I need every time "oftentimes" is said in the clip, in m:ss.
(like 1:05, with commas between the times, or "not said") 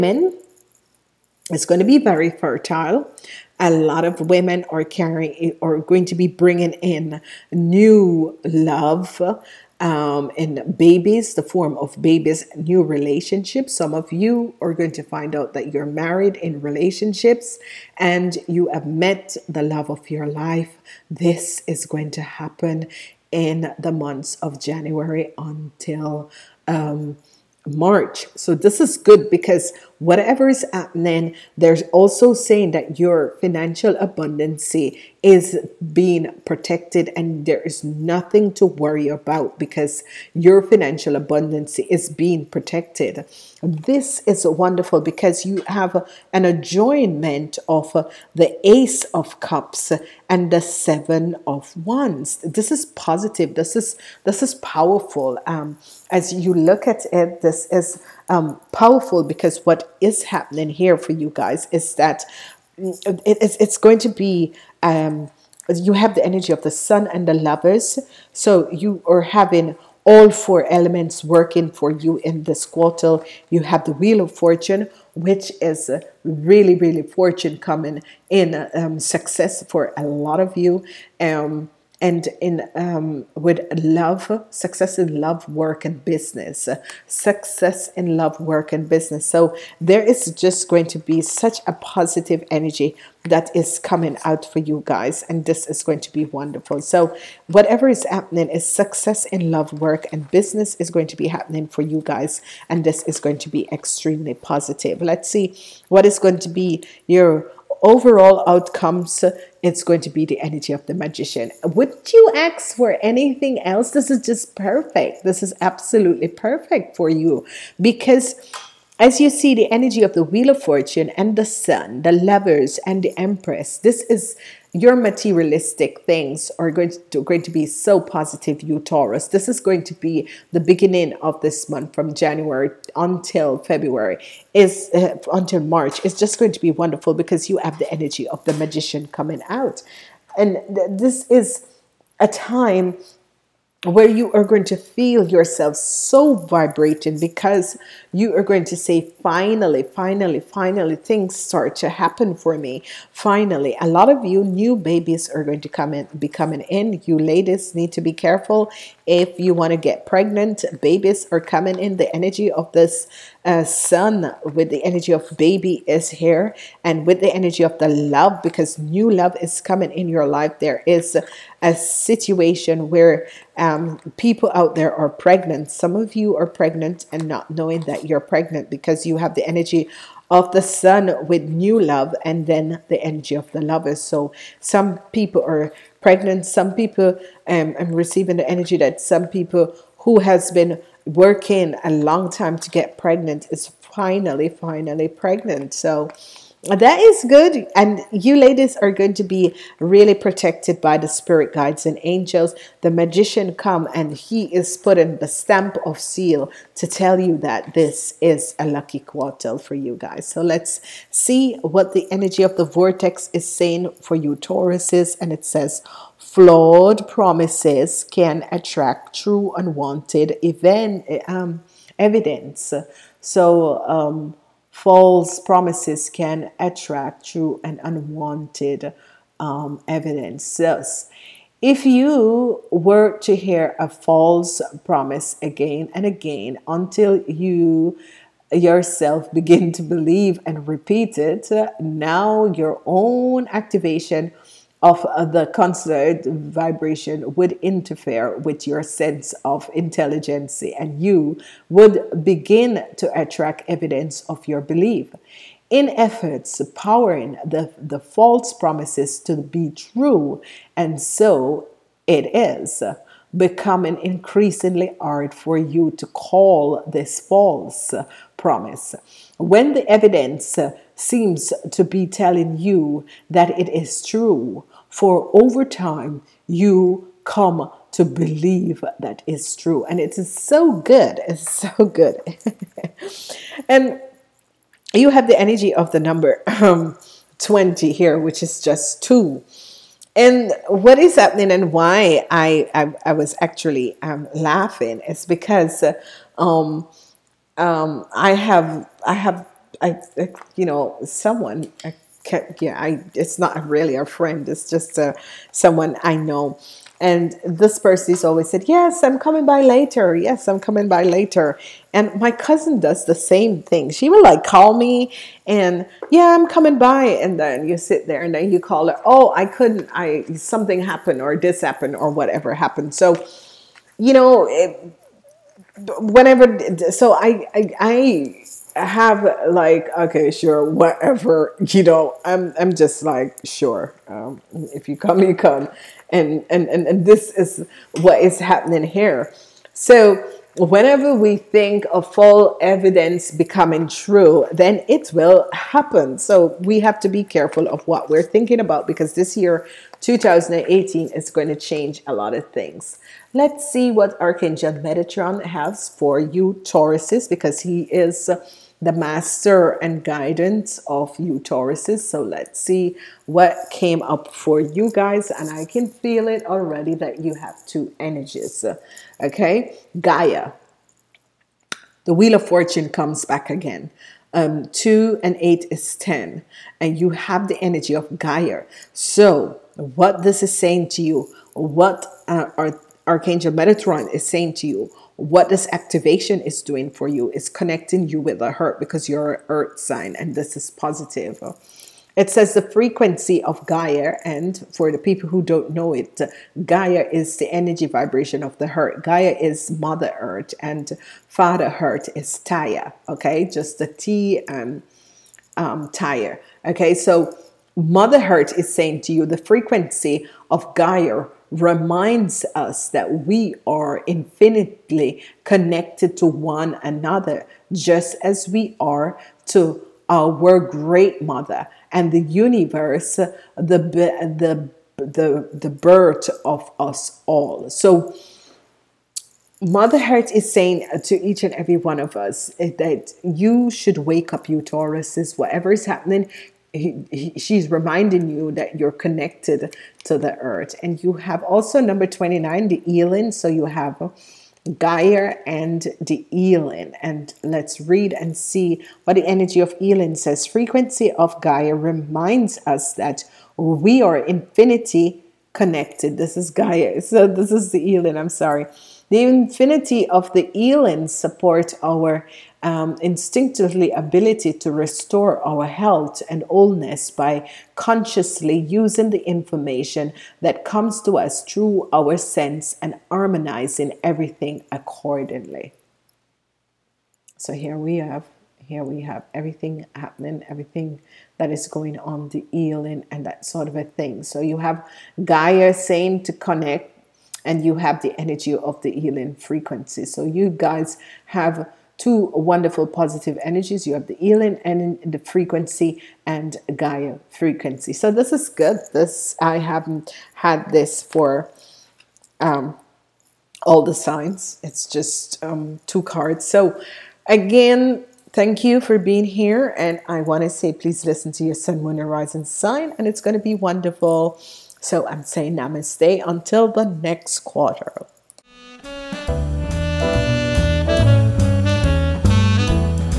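not said.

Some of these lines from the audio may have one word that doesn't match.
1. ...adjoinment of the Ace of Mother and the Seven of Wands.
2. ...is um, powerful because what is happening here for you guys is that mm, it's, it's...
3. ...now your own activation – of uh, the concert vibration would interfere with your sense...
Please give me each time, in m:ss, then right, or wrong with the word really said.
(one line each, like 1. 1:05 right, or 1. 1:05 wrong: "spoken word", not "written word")
1. 0:46 wrong: "Cups", not "Mother"
2. 0:57 right
3. 4:01 right.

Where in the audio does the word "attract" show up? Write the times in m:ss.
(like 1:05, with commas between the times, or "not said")
3:38, 3:46, 4:13.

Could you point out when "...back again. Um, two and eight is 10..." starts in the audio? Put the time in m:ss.
6:13.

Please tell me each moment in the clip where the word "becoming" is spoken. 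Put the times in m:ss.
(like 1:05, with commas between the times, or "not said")
4:23, 5:43.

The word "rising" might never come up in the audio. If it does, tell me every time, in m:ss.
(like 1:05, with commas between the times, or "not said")
8:32.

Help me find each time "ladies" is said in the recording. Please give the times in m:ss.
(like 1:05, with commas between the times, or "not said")
2:37, 3:18.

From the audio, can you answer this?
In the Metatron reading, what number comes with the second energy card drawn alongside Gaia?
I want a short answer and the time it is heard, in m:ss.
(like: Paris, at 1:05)
29, at 7:22.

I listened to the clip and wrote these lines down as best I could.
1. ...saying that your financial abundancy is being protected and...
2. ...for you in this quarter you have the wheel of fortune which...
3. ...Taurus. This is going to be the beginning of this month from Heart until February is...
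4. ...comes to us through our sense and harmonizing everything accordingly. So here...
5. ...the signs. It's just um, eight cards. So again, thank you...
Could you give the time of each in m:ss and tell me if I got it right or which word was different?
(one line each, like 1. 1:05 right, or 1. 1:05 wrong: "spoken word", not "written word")
1. 0:32 right
2. 1:11 right
3. 2:08 wrong: "January", not "Heart"
4. 7:50 right
5. 8:23 wrong: "two", not "eight".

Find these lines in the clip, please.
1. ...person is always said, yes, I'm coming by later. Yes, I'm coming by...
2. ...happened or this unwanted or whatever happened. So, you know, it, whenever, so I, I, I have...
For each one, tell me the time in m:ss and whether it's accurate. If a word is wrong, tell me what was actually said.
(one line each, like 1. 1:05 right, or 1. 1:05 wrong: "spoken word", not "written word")
1. 5:07 right
2. 5:20 wrong: "happened", not "unwanted".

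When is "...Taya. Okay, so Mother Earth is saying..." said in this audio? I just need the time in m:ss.
6:45.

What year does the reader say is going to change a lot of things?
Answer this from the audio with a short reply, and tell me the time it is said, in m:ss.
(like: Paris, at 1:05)
2018, at 5:50.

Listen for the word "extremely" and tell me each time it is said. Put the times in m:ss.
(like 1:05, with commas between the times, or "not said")
1:43.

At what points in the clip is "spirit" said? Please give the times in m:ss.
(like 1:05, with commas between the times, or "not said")
3:21.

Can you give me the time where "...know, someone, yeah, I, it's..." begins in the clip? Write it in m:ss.
5:00.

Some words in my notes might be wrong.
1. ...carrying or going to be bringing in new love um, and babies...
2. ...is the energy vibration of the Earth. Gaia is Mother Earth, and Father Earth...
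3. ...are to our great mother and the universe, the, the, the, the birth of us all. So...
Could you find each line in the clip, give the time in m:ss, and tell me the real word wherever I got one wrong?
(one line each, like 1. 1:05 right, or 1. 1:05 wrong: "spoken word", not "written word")
1. 0:04 right
2. 6:37 right
3. 6:58 right.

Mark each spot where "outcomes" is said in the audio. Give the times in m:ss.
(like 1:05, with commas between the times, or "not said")
1:48.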